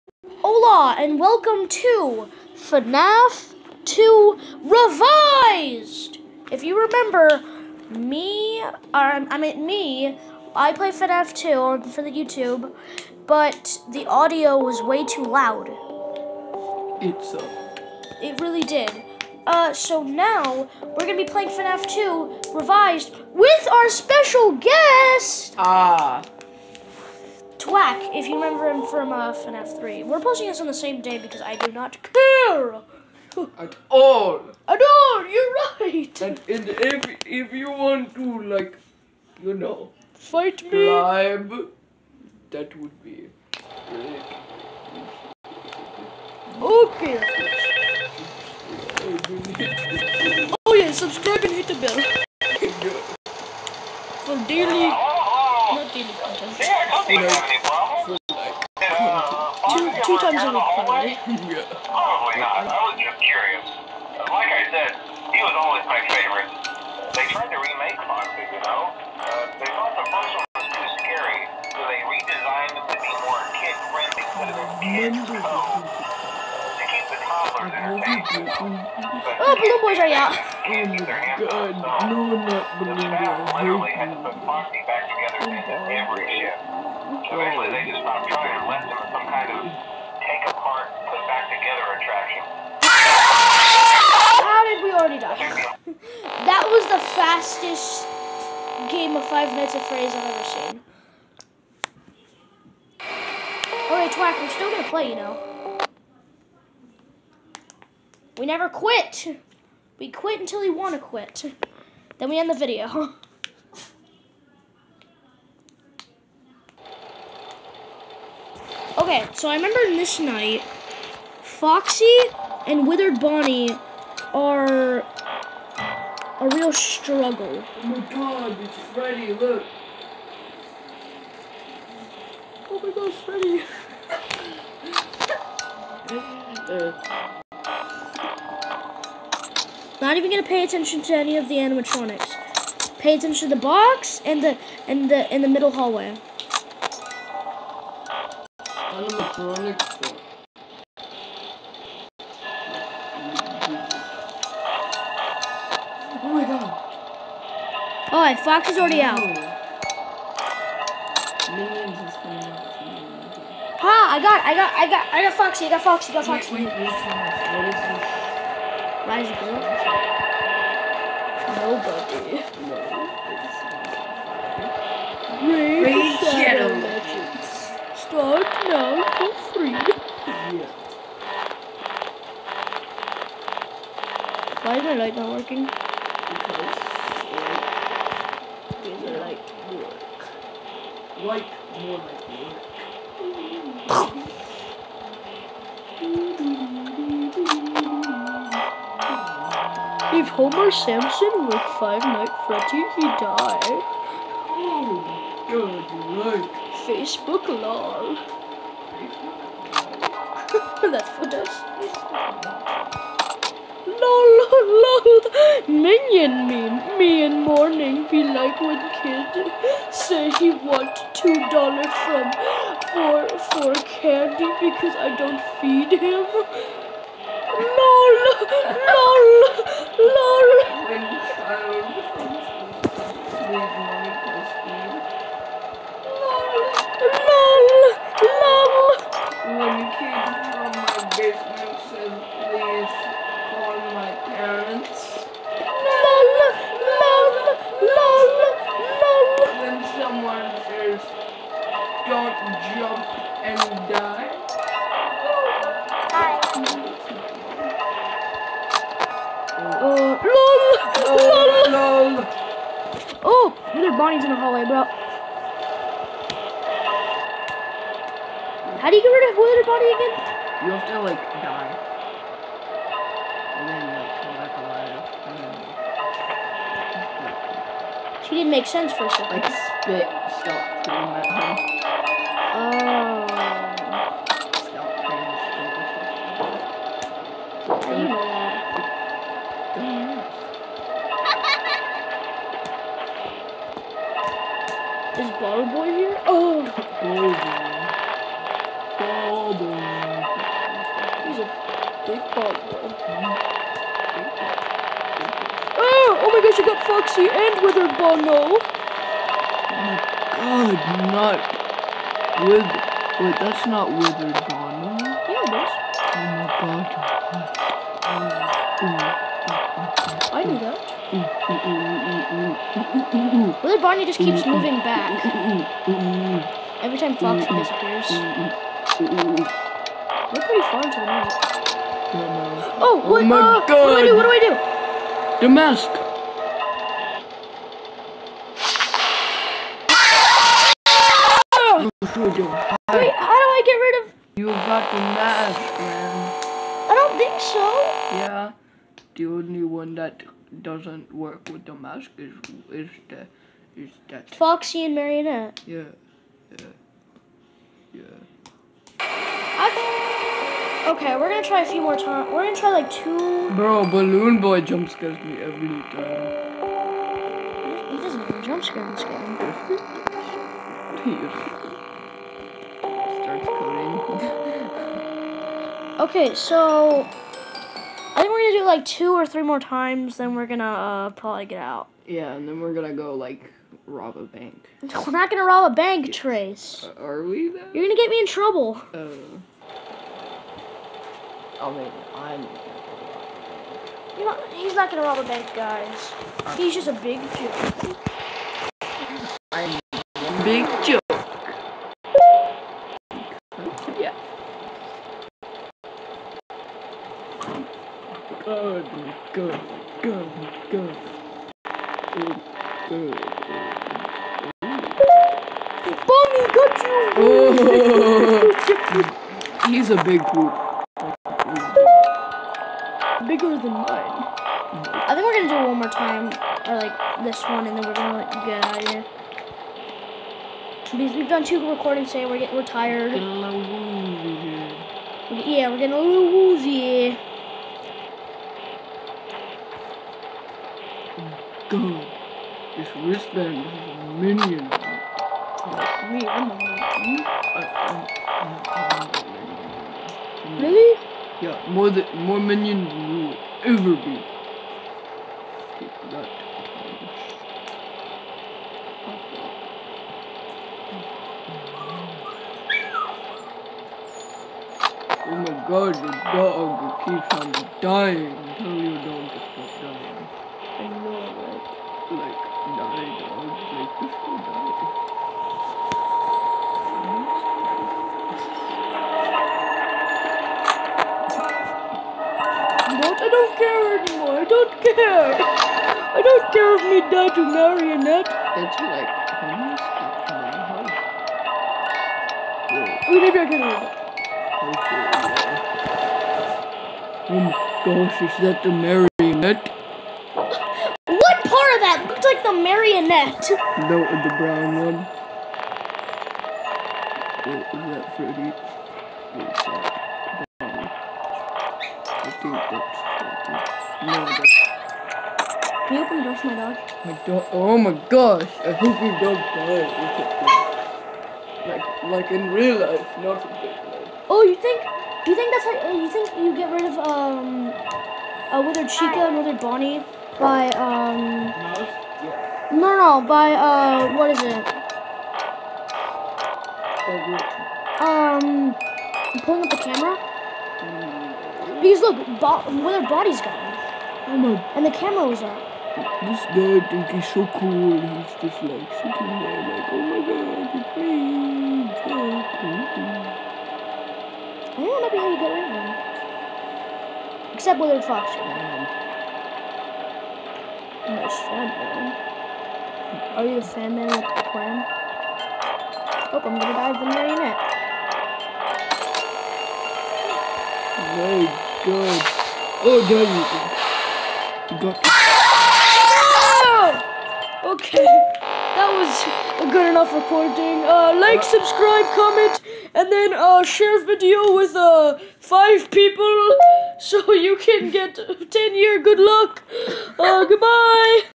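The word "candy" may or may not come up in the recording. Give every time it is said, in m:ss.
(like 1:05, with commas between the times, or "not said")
3:43.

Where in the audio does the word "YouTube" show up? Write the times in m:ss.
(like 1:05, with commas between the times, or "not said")
0:12.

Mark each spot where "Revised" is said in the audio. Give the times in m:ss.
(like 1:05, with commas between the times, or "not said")
0:04, 0:22.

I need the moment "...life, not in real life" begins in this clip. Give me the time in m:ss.
8:42.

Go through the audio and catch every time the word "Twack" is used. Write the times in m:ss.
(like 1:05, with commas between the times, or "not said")
0:27, 1:44.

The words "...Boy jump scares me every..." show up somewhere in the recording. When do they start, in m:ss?
6:04.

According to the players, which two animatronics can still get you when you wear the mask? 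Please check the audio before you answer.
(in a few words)
Foxy and Marionette.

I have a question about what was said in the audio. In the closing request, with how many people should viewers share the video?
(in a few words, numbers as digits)
5.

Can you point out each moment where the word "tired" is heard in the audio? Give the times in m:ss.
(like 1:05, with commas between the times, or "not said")
7:12.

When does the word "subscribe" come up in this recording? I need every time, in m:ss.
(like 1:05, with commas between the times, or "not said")
0:50, 9:41.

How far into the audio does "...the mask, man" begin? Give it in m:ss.
5:44.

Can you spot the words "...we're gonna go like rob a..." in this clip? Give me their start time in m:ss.
6:22.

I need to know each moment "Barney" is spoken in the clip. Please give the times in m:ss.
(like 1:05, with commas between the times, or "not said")
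5:23.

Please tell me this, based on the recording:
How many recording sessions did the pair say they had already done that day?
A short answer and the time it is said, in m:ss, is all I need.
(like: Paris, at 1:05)
2, at 7:11.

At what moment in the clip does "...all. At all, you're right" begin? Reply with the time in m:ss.
0:33.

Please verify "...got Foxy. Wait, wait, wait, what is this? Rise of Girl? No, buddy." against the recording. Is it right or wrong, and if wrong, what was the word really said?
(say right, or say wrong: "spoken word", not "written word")
right.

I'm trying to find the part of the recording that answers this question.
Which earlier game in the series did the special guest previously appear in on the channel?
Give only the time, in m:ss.
0:29.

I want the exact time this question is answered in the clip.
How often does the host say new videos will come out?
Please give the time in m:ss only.
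1:00.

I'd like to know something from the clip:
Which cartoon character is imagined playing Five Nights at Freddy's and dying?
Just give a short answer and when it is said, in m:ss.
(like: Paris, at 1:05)
Homer Simpson, at 3:20.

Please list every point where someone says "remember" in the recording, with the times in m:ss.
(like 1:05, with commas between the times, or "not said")
0:06, 0:28, 1:59.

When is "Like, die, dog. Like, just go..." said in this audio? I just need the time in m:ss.
7:52.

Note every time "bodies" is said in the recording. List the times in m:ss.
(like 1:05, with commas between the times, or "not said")
9:03.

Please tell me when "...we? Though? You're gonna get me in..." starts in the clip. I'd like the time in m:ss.
6:27.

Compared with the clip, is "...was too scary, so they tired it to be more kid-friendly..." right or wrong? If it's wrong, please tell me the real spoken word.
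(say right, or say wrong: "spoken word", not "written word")
wrong: "redesigned", not "tired".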